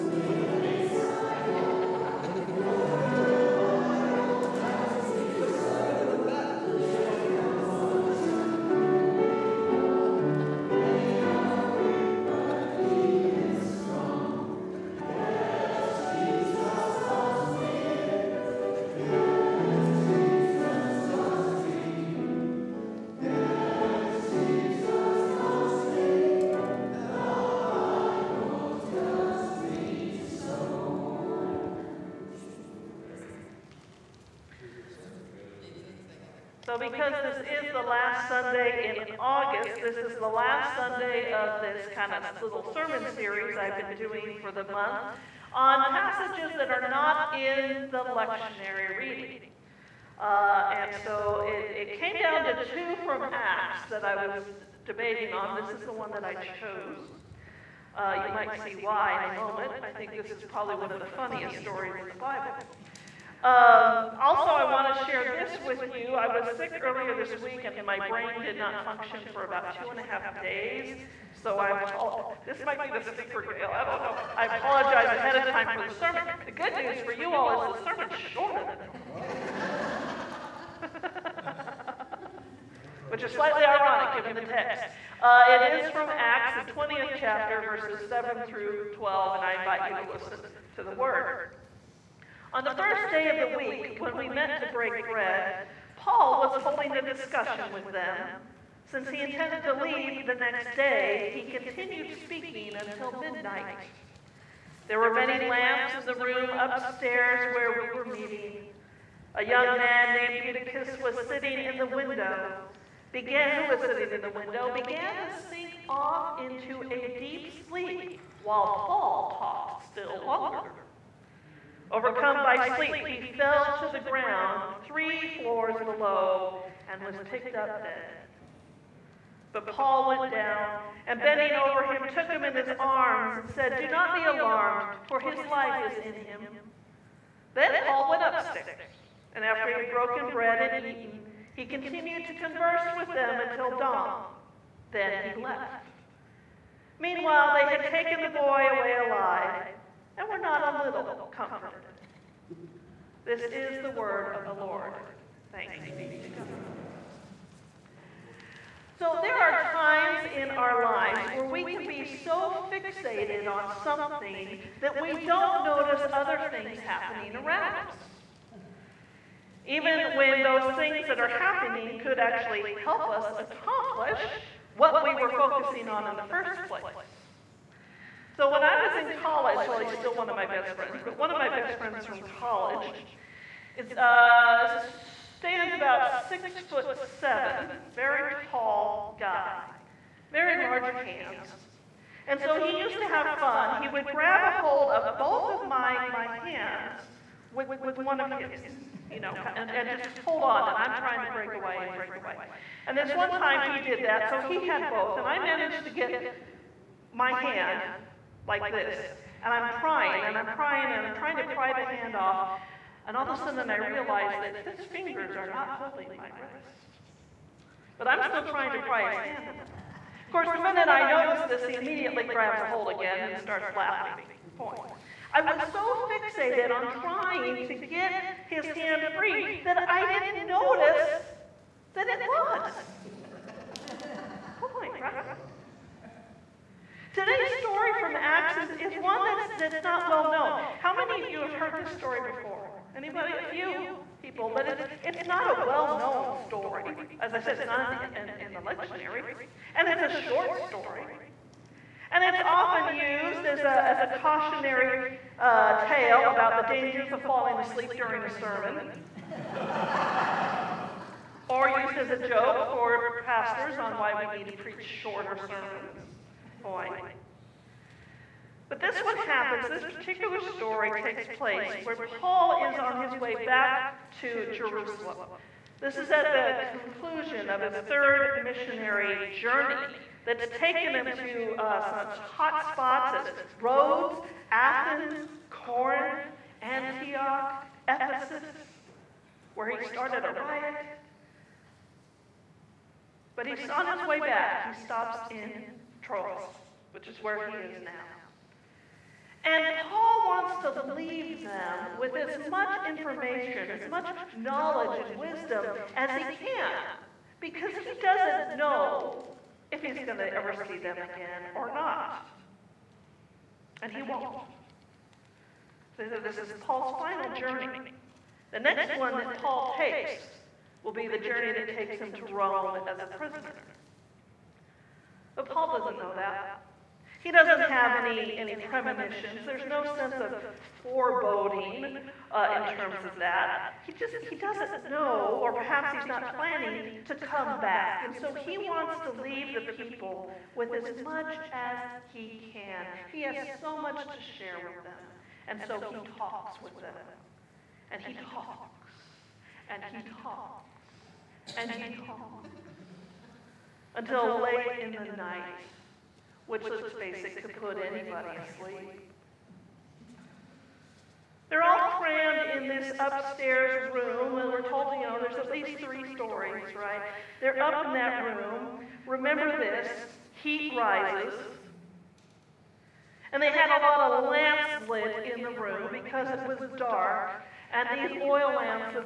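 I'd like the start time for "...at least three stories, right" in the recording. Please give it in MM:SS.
06:05.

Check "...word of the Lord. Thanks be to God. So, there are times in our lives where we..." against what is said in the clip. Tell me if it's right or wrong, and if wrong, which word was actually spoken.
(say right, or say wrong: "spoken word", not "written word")
right.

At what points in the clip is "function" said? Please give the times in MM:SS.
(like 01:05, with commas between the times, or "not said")
01:08.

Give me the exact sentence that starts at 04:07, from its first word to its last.
As I said, it's not in the, in, in the lectionary.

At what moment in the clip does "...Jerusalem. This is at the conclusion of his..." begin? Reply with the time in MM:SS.
04:34.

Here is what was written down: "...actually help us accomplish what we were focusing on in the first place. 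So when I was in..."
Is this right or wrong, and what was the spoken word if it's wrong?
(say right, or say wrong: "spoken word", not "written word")
right.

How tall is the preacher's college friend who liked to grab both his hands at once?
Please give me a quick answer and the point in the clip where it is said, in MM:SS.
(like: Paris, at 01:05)
6 foot 7, at 03:06.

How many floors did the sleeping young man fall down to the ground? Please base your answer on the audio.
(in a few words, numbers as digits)
3.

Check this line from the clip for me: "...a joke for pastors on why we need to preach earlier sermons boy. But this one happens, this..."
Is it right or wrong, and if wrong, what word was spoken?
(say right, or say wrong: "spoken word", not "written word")
wrong: "shorter", not "earlier".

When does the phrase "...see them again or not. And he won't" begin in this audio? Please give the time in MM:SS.
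05:10.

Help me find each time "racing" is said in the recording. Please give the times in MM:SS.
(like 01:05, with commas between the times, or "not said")
not said.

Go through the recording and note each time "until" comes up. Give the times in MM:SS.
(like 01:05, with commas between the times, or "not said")
01:42, 02:23, 05:53.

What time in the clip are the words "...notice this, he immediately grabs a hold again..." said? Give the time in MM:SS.
03:41.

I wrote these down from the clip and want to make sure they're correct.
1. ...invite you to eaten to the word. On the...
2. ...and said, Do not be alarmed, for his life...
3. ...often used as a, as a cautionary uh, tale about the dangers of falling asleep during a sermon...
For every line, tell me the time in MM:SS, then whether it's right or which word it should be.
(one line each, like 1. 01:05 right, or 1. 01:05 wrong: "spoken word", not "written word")
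1. 01:29 wrong: "listen", not "eaten"
2. 02:13 right
3. 04:12 right.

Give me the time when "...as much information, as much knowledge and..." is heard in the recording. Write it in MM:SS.
05:02.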